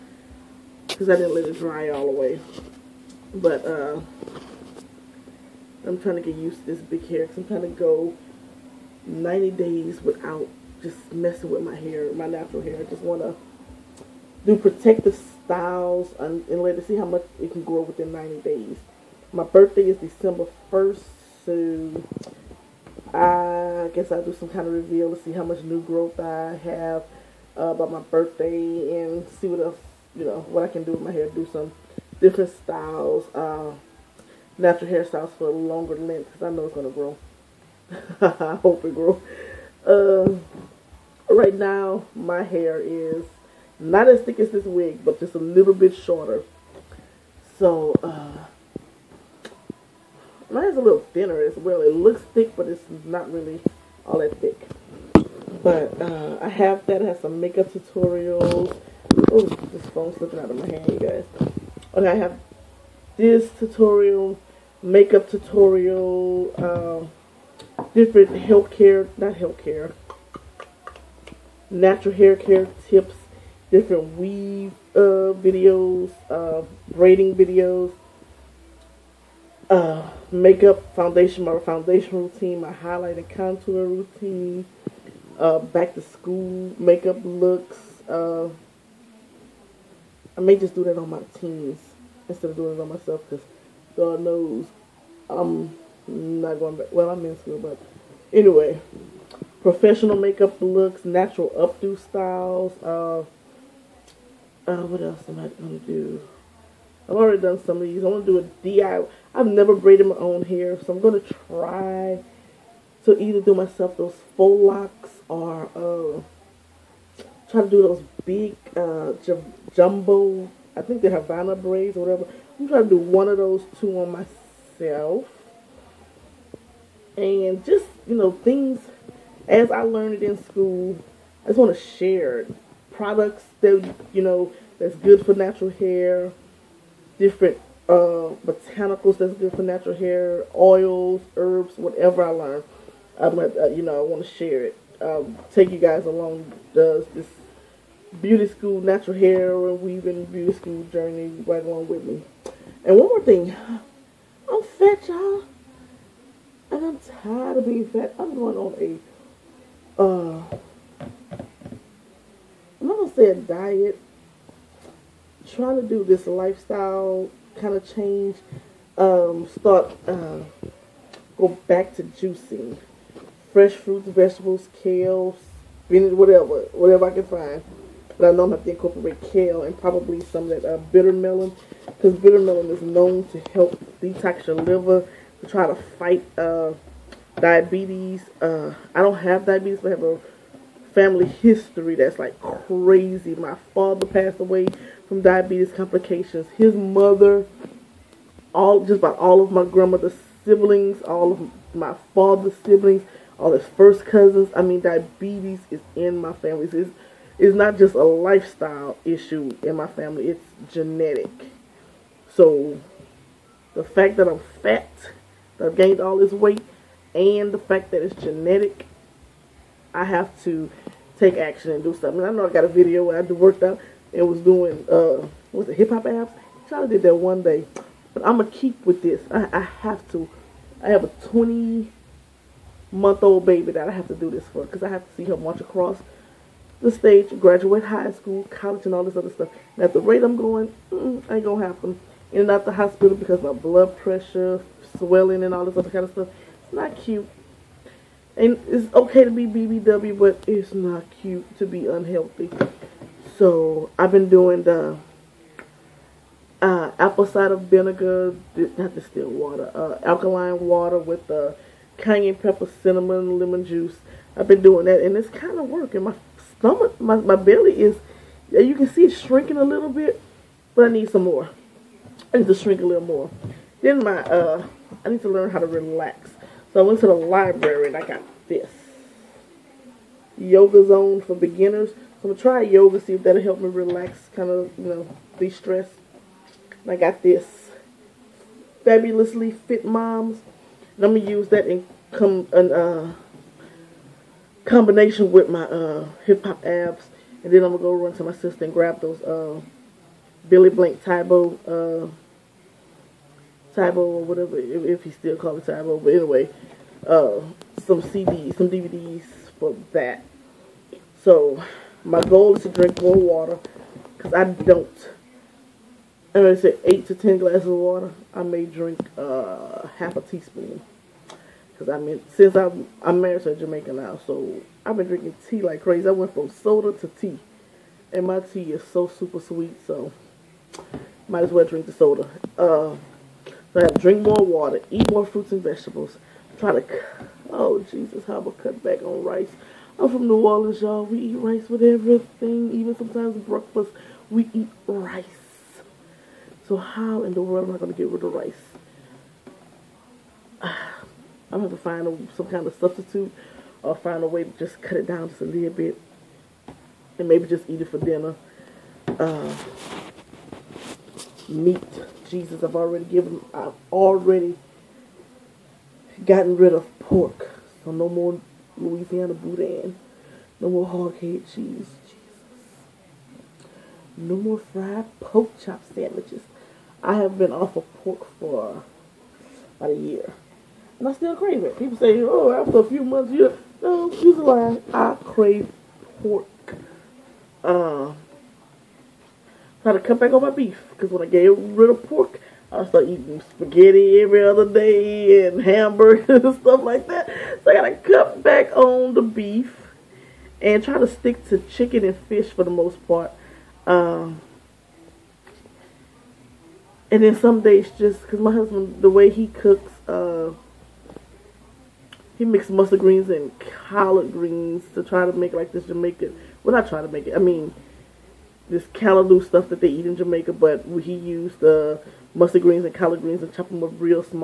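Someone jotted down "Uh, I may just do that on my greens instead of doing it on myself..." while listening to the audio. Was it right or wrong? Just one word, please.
wrong.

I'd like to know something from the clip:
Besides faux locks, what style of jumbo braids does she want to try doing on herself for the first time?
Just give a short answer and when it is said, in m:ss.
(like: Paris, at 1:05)
Havana braids, at 2:01.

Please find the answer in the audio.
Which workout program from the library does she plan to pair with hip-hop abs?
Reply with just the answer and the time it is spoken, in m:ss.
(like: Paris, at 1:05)
Fabulously Fit Moms, at 4:48.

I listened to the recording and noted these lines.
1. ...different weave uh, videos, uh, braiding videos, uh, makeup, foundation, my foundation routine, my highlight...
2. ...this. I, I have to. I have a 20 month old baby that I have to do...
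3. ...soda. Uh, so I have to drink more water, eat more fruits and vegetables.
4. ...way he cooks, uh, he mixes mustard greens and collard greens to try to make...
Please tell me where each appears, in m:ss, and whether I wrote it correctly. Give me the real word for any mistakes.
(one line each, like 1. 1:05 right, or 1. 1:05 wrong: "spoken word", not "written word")
1. 1:13 right
2. 3:49 right
3. 5:31 right
4. 6:49 right.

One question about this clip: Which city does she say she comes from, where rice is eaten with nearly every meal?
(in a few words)
New Orleans.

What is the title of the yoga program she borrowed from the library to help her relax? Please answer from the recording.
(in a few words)
Yoga Zone.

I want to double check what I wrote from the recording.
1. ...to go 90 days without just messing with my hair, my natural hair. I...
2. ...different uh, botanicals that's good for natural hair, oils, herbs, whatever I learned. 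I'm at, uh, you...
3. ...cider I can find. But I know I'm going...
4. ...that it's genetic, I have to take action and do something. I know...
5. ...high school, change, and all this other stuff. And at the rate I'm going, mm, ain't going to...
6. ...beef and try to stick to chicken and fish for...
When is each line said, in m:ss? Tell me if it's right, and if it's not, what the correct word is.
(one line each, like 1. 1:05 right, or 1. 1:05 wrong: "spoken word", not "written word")
1. 0:07 right
2. 2:17 right
3. 2:56 wrong: "whatever", not "cider"
4. 3:37 right
5. 3:57 wrong: "college", not "change"
6. 6:39 right.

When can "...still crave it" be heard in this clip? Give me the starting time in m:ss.
6:21.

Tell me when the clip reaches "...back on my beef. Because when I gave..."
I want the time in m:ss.
6:30.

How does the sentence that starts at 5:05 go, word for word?
But anyway, uh, some CDs, some DVDs for that.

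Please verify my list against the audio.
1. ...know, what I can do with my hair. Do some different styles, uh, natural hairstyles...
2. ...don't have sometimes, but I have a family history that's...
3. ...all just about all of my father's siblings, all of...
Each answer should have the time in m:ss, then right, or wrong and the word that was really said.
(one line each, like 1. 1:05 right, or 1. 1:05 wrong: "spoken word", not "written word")
1. 0:30 right
2. 3:09 wrong: "diabetes", not "sometimes"
3. 3:18 wrong: "grandmother", not "father".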